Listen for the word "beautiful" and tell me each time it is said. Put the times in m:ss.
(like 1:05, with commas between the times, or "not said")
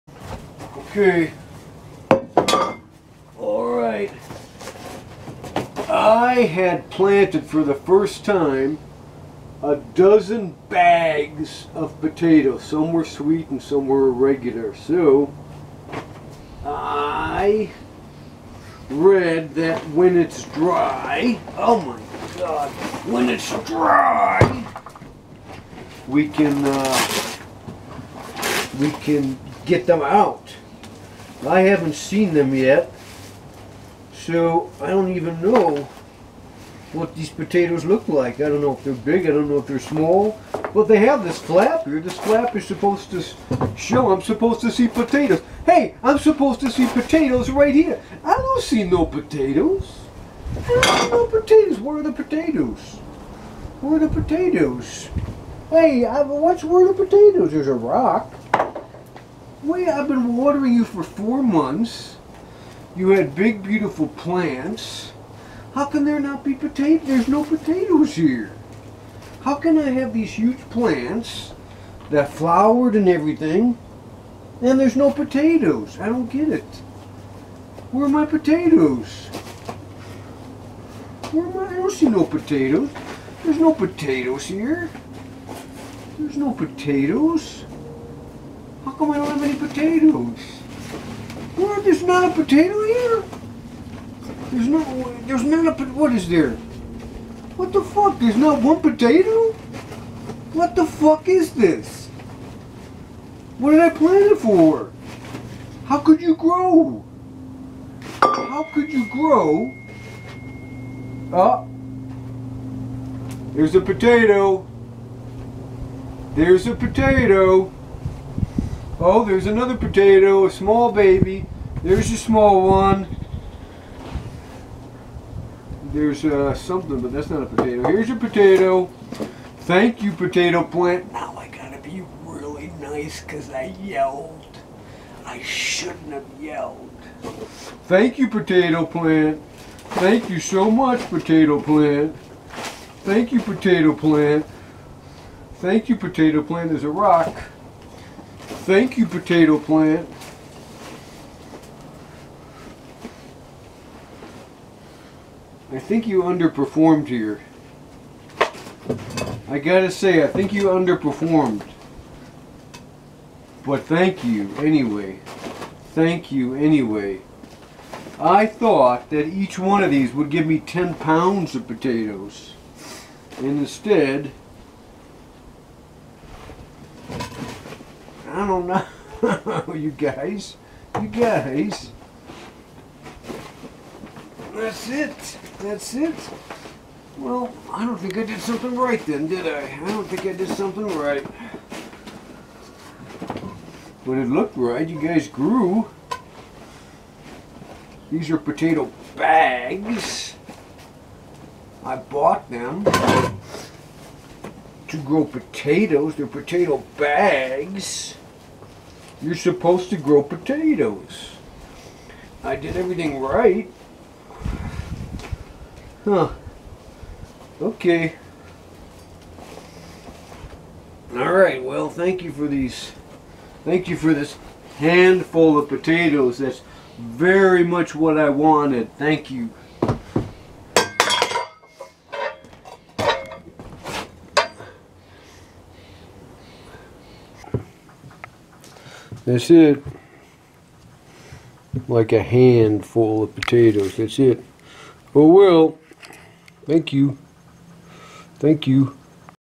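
1:03.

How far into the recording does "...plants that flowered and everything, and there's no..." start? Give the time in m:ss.
1:10.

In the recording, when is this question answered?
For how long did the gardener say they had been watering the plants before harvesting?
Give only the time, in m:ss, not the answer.
1:01.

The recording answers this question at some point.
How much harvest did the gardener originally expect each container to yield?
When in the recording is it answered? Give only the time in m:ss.
2:50.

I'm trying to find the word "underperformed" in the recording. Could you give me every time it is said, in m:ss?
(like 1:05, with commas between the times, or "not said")
2:36, 2:40.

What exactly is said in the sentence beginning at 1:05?
How can there not be potatoes?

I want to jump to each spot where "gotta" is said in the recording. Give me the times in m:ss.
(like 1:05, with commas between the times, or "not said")
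2:11, 2:39.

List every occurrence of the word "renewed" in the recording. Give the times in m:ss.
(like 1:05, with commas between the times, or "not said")
not said.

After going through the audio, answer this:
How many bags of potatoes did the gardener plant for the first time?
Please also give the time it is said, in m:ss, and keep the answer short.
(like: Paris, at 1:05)
12, at 0:09.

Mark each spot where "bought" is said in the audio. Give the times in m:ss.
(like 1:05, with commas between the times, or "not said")
3:21.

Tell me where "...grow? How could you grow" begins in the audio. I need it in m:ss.
1:46.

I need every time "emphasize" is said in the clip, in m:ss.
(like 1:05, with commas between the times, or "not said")
not said.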